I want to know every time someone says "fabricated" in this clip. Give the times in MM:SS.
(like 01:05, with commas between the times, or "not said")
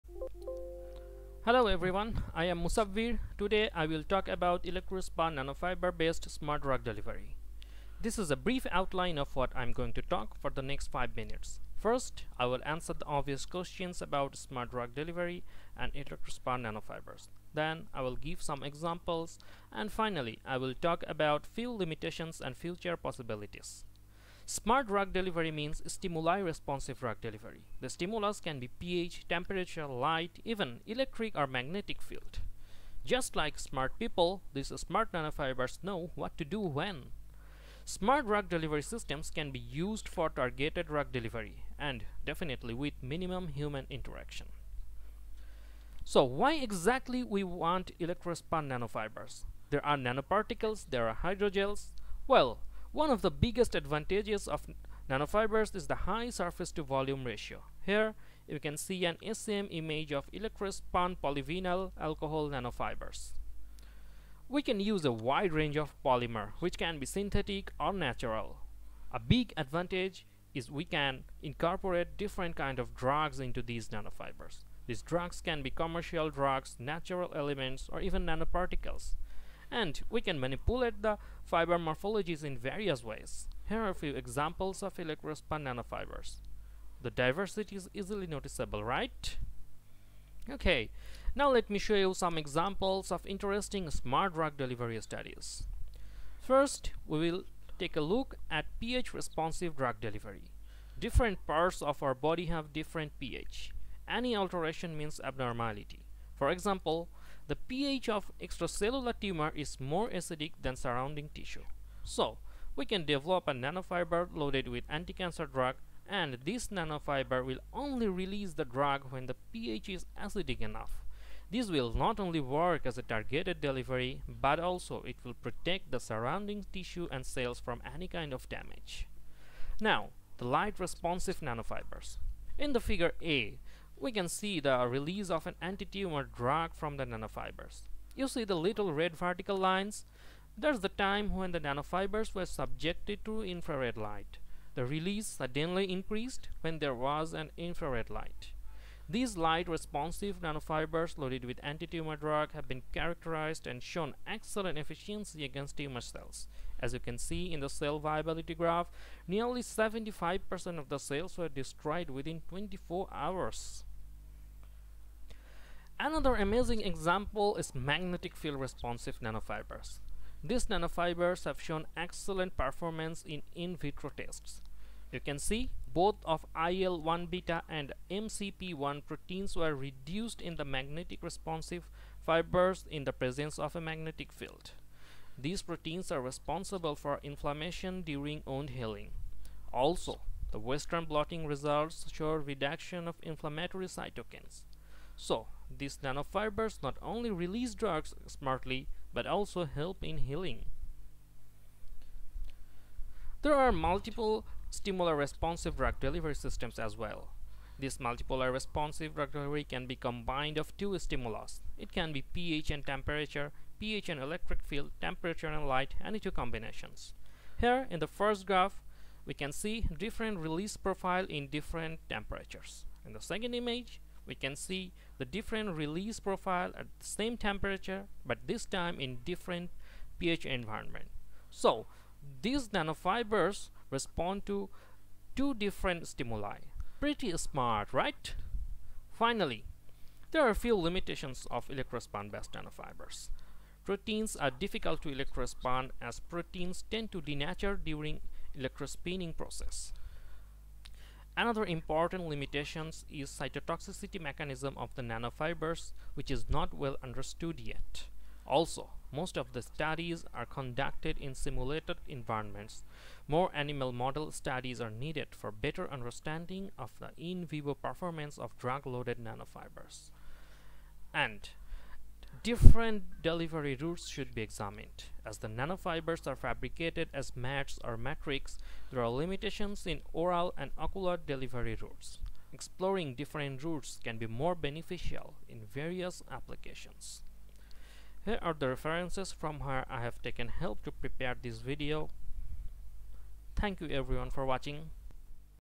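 04:36.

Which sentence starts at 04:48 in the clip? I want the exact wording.
Here are the references from where I have taken help to prepare this video.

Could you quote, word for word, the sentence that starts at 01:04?
We can use a wide range of polymer which can be synthetic or natural.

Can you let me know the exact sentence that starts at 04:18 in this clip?
Also, most of the studies are conducted in simulated environments.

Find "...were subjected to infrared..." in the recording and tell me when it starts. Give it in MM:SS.
02:22.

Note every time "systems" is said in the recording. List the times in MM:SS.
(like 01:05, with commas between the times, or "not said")
00:38, 03:26.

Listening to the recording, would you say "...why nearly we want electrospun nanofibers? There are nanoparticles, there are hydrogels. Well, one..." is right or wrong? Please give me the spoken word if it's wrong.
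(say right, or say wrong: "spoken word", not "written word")
wrong: "exactly", not "nearly".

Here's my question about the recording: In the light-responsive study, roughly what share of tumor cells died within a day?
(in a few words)
75%.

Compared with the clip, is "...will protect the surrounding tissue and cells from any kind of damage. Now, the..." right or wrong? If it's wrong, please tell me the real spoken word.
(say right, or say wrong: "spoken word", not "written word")
right.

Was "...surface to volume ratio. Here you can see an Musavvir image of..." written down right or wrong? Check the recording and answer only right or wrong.
wrong.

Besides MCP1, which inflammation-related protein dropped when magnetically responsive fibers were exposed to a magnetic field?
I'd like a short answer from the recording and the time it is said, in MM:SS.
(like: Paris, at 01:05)
IL-1 beta, at 02:56.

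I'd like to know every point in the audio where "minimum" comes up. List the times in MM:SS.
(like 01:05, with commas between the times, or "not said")
00:43.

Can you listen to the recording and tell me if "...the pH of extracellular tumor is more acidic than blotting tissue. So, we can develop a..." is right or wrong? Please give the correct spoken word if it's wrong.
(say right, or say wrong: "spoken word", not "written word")
wrong: "surrounding", not "blotting".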